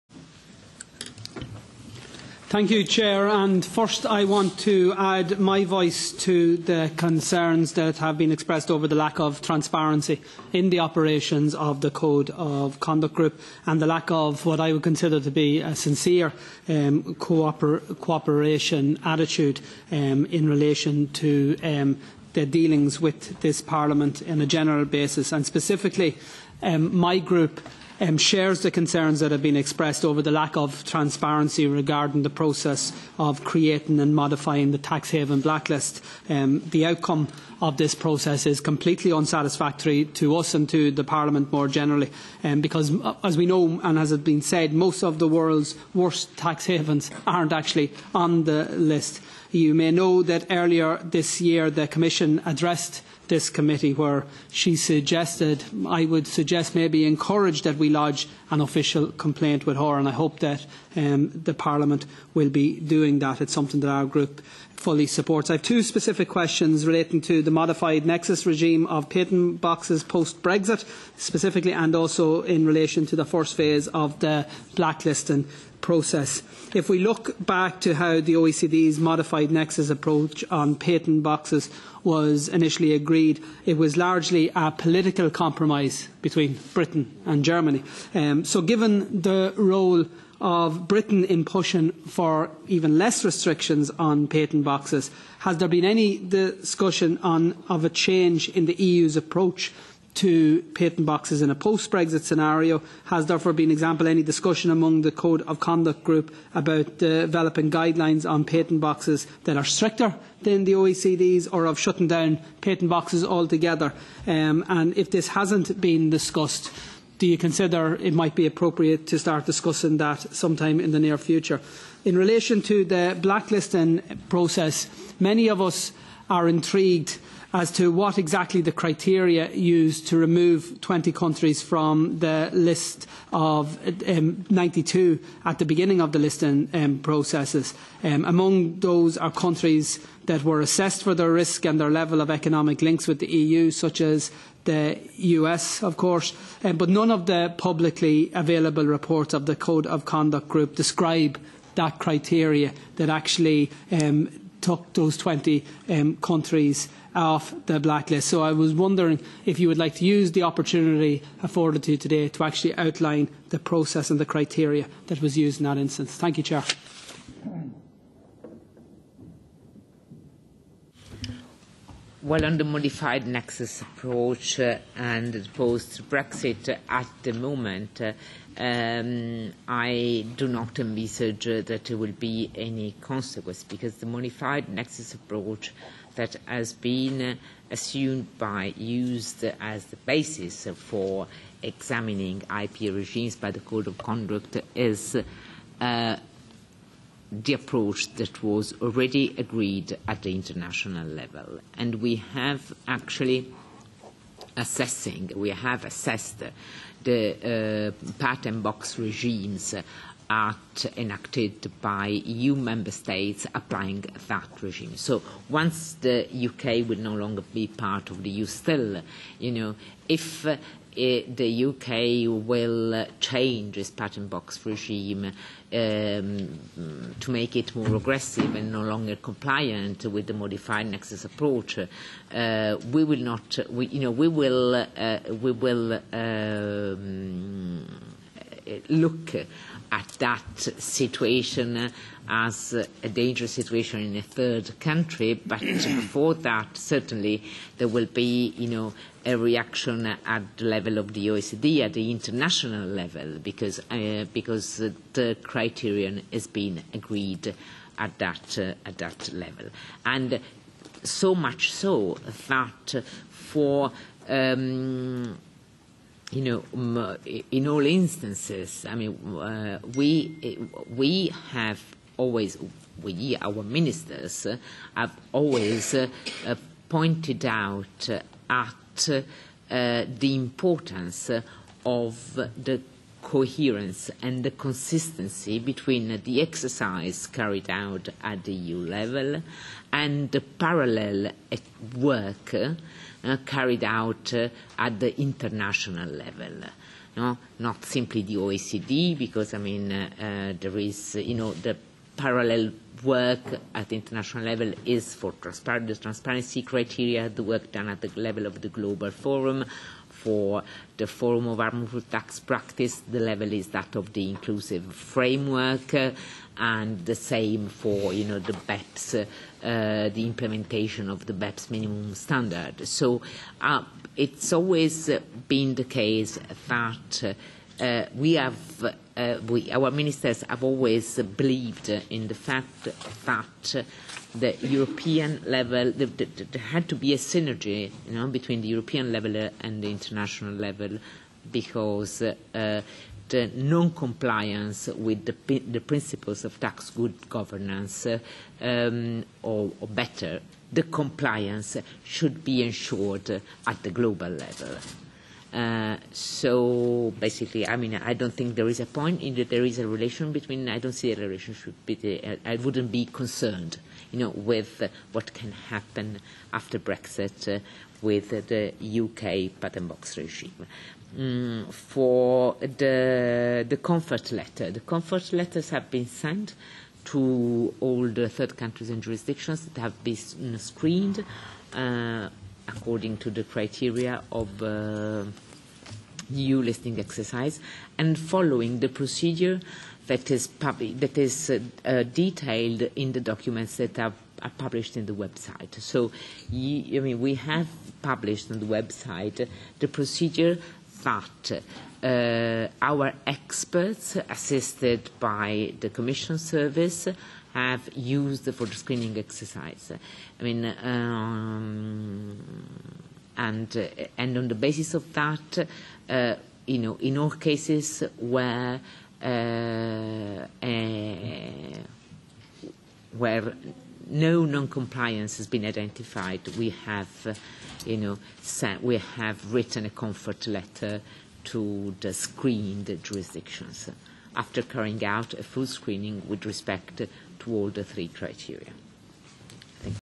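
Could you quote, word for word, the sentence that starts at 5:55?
Uh, so basically, I mean, I don't think there is a point in that there is a relation between.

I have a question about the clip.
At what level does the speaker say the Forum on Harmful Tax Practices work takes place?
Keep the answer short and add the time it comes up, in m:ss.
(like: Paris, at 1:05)
inclusive framework, at 5:14.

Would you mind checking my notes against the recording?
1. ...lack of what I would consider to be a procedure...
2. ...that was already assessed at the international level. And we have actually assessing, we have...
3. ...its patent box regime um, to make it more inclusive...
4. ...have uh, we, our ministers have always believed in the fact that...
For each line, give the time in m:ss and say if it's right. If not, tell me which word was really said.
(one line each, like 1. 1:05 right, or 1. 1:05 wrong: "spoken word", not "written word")
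1. 0:13 wrong: "sincere", not "procedure"
2. 3:18 wrong: "agreed", not "assessed"
3. 3:43 wrong: "aggressive", not "inclusive"
4. 5:28 right.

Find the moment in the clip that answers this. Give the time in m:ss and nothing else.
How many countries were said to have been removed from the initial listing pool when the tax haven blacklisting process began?
2:10.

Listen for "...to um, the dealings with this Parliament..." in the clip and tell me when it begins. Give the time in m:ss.
0:21.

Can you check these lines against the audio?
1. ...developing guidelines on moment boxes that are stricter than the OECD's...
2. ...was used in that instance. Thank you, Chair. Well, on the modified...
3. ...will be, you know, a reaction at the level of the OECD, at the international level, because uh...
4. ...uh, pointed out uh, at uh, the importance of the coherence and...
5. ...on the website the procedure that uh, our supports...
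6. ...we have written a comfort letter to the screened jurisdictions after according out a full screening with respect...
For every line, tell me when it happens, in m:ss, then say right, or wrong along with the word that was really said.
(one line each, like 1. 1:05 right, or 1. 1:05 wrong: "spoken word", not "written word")
1. 1:46 wrong: "patent", not "moment"
2. 2:45 right
3. 4:07 right
4. 4:35 right
5. 6:38 wrong: "experts", not "supports"
6. 7:08 wrong: "carrying", not "according".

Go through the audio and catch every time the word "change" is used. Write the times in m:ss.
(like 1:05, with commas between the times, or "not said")
1:37, 3:43.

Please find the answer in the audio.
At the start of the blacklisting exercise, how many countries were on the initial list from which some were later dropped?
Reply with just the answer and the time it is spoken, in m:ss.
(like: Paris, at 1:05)
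92, at 2:14.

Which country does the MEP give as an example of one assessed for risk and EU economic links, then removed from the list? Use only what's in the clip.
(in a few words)
the US.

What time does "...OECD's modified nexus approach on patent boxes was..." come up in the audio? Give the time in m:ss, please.
1:18.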